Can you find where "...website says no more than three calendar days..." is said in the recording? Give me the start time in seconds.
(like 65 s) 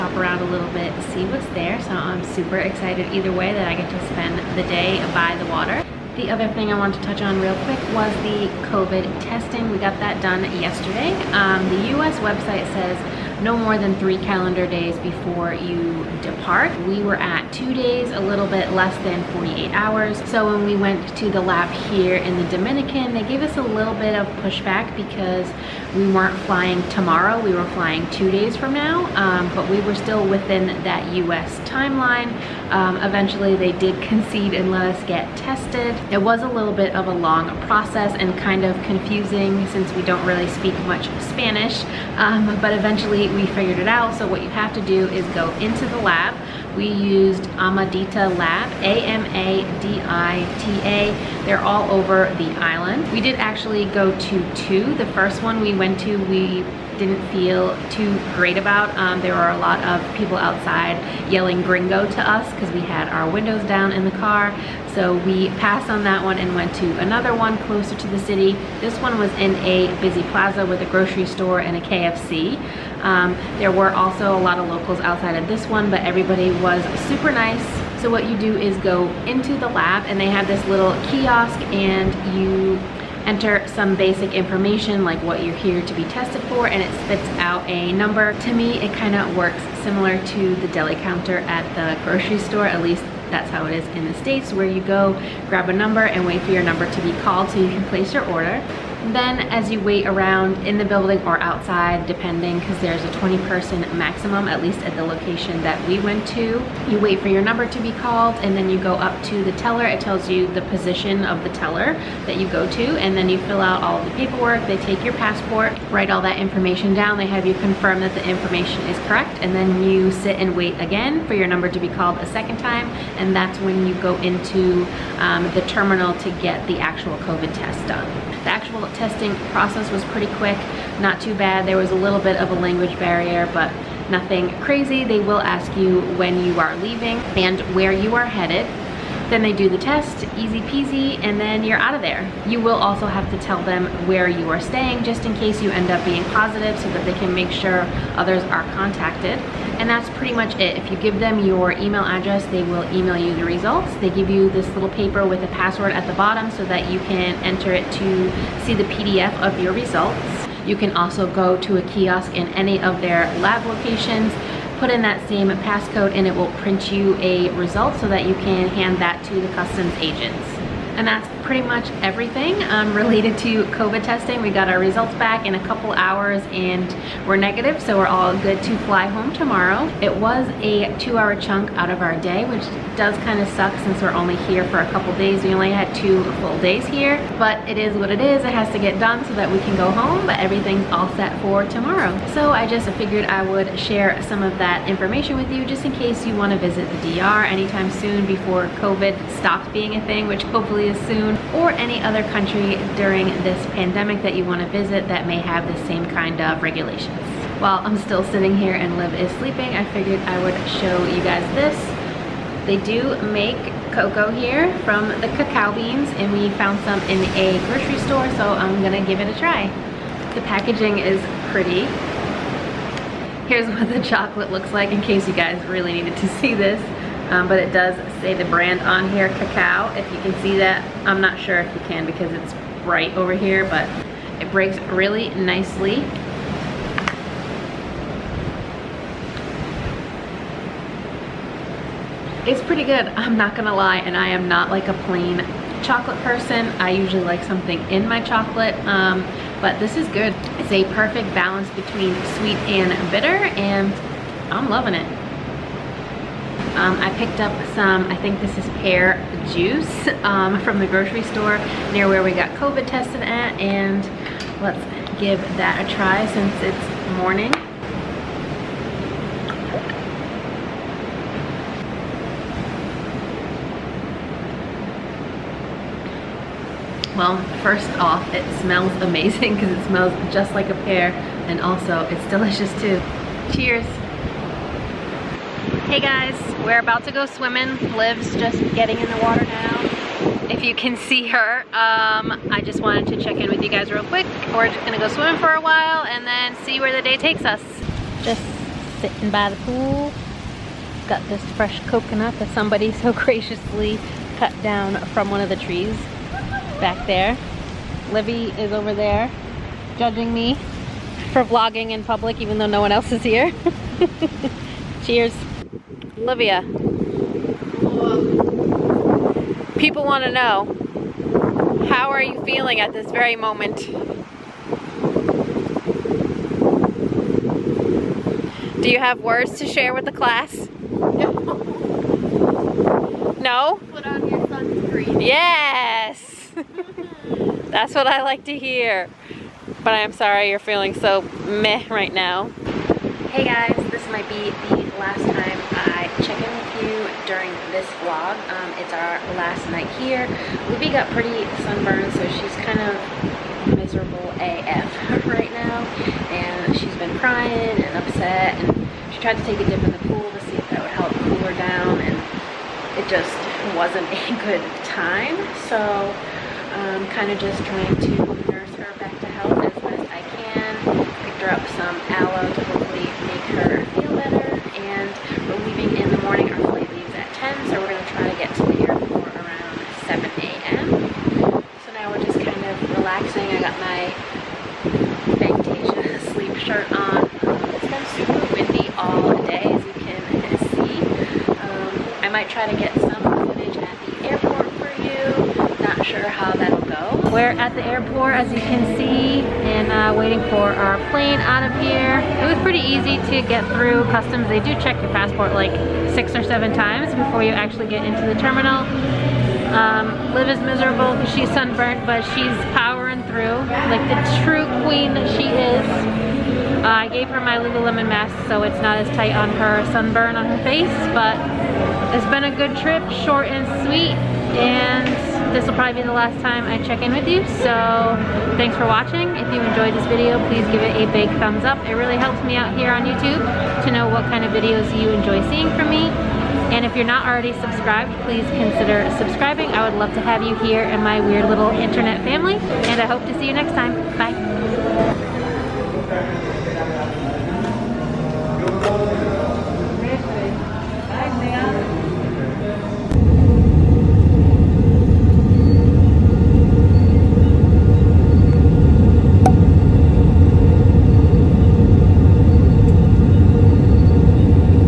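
12 s.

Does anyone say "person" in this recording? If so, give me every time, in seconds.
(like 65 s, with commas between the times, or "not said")
103 s, 246 s.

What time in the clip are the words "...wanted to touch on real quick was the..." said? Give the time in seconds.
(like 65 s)
6 s.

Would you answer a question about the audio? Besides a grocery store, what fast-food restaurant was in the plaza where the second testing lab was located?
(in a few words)
KFC.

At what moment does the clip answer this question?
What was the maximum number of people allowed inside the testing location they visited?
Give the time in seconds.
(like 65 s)
103 s.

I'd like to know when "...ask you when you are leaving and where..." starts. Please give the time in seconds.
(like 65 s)
135 s.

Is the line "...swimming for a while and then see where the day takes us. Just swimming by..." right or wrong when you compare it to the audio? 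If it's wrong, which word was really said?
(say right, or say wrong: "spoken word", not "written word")
wrong: "sitting", not "swimming".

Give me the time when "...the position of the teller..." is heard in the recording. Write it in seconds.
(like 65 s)
110 s.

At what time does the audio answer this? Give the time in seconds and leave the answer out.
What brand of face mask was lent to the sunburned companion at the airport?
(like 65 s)
417 s.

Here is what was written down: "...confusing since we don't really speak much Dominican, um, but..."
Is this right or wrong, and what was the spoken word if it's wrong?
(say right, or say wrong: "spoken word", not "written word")
wrong: "Spanish", not "Dominican".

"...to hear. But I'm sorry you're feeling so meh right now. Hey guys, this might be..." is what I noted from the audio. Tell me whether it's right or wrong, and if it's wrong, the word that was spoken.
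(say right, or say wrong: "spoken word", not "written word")
right.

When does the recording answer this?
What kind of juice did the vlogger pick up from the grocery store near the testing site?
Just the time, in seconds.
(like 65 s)
258 s.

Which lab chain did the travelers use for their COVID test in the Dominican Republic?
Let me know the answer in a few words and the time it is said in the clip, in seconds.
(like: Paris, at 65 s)
Amadita Lab, at 47 s.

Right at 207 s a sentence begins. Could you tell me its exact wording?
While I'm still sitting here and Liv is sleeping, I figured I would show you guys this.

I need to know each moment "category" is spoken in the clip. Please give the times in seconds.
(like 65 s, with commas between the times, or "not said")
not said.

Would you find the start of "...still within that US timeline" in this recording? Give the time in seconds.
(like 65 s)
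29 s.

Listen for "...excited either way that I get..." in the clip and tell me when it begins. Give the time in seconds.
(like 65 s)
2 s.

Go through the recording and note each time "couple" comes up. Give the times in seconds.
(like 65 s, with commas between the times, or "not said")
175 s, 184 s.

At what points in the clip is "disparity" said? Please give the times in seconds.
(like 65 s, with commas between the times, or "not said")
not said.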